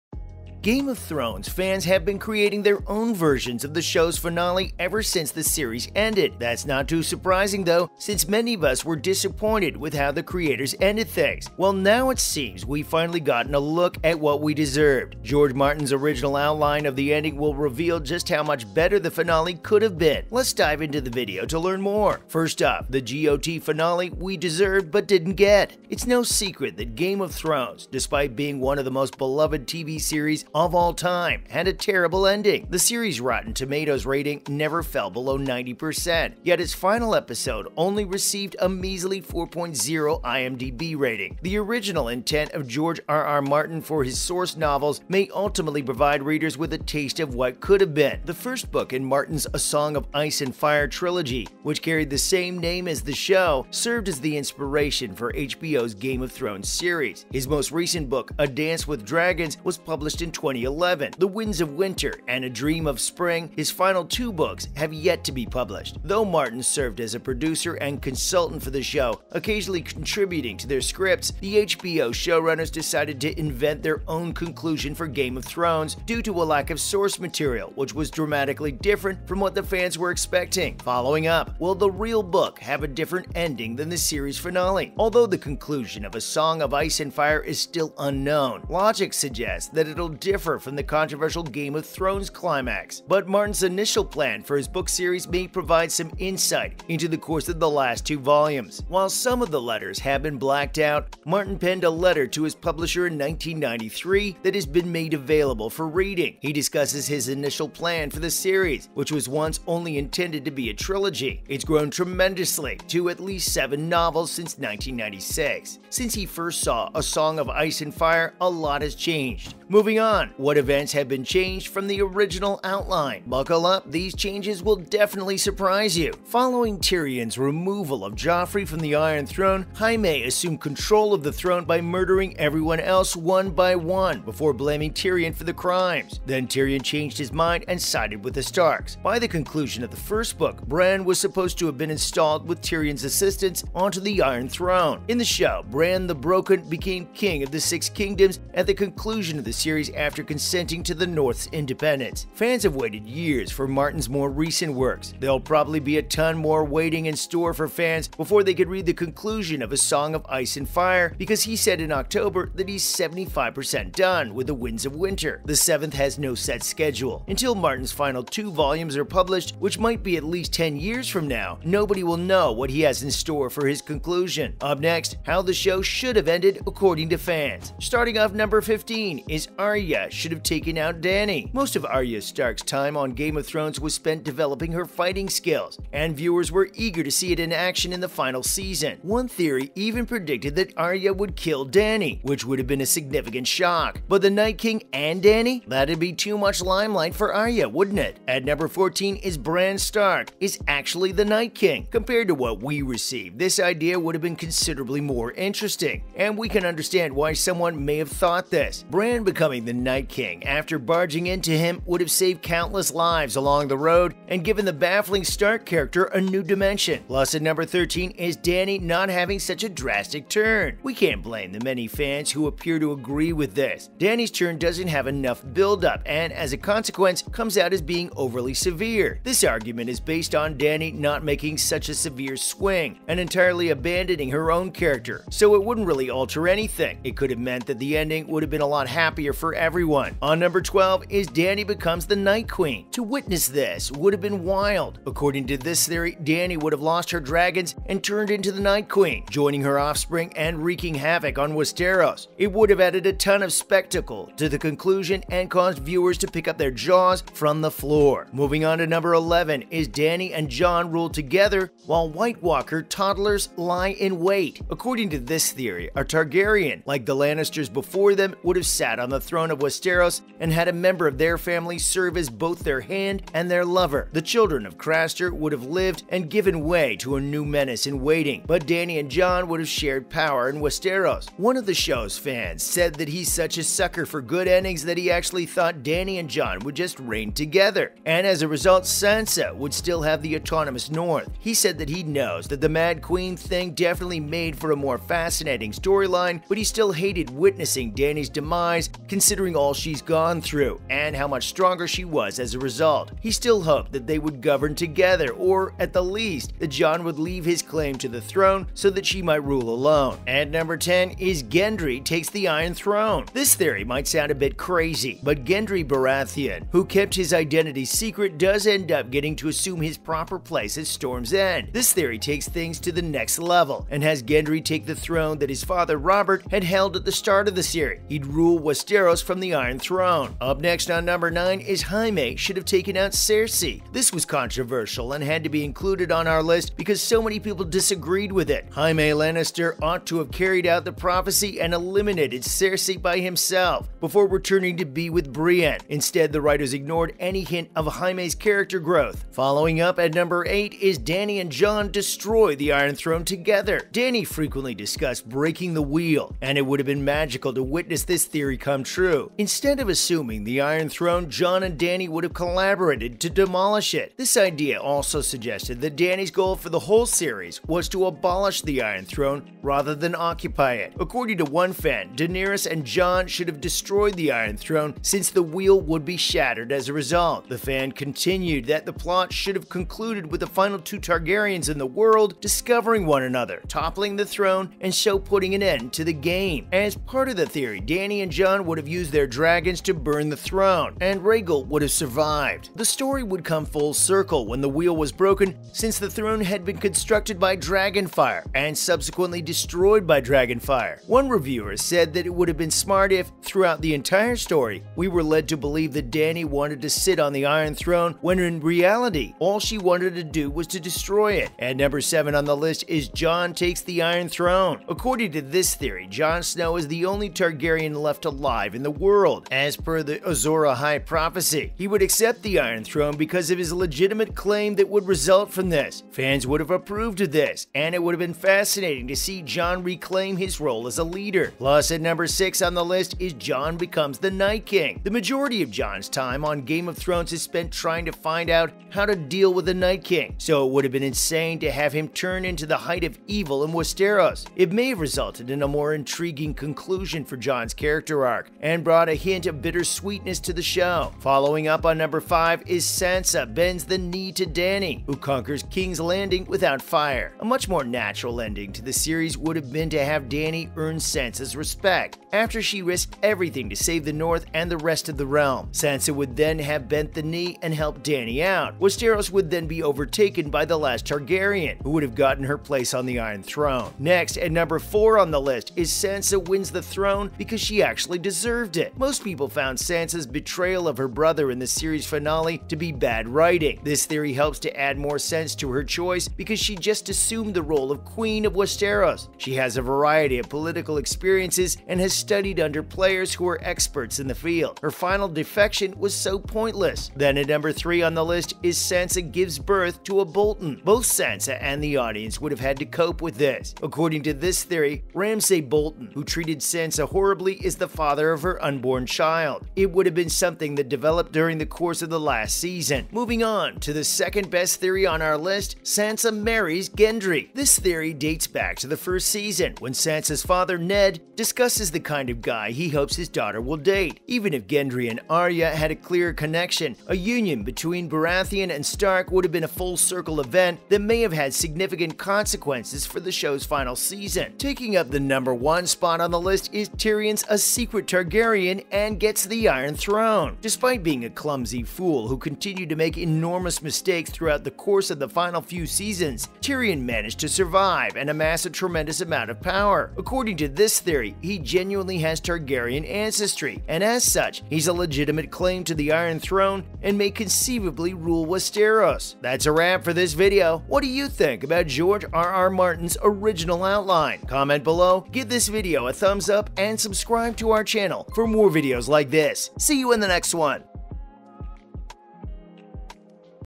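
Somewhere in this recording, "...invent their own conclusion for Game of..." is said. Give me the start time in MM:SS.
01:13.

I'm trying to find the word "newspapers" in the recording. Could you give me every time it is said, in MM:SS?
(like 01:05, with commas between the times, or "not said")
not said.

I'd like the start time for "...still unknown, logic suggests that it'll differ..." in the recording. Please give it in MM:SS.
01:27.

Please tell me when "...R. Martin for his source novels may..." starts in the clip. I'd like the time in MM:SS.
00:43.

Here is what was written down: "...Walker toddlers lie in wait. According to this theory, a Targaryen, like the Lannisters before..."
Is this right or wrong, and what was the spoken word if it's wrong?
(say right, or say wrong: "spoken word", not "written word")
right.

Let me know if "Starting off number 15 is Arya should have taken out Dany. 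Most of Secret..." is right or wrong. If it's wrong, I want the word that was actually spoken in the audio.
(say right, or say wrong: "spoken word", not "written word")
wrong: "Arya", not "Secret".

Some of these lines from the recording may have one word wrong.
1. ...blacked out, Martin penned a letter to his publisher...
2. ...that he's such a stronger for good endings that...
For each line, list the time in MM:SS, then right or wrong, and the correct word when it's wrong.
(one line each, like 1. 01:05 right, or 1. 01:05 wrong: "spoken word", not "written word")
1. 01:40 right
2. 04:42 wrong: "sucker", not "stronger".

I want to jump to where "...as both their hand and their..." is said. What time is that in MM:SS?
04:32.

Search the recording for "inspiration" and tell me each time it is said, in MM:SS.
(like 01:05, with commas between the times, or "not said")
00:54.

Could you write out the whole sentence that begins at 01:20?
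Following up, will the real book have a different ending than the series finale?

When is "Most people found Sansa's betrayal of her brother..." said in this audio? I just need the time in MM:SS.
07:58.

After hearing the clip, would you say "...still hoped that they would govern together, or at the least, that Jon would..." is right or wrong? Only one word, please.
right.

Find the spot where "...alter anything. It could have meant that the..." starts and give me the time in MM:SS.
03:56.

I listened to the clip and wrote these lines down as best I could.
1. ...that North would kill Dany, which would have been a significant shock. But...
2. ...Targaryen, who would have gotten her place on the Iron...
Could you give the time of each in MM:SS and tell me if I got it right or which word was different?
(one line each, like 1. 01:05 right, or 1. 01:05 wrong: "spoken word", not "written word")
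1. 03:10 wrong: "Arya", not "North"
2. 07:51 right.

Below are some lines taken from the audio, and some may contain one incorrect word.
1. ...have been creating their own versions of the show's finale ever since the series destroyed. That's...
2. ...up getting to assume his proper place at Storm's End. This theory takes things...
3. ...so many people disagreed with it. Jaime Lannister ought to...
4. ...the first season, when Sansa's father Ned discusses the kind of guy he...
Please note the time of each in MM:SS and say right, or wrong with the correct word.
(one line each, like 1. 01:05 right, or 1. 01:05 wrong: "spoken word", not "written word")
1. 00:01 wrong: "ended", not "destroyed"
2. 05:18 right
3. 05:37 right
4. 08:38 right.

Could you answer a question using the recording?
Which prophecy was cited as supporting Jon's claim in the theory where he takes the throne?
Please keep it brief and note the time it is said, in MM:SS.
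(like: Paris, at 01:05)
Azor Ahai, at 07:00.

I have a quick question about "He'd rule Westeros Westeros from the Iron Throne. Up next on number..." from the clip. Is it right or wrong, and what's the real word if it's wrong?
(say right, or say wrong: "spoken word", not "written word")
right.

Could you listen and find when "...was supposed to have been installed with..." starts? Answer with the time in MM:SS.
02:21.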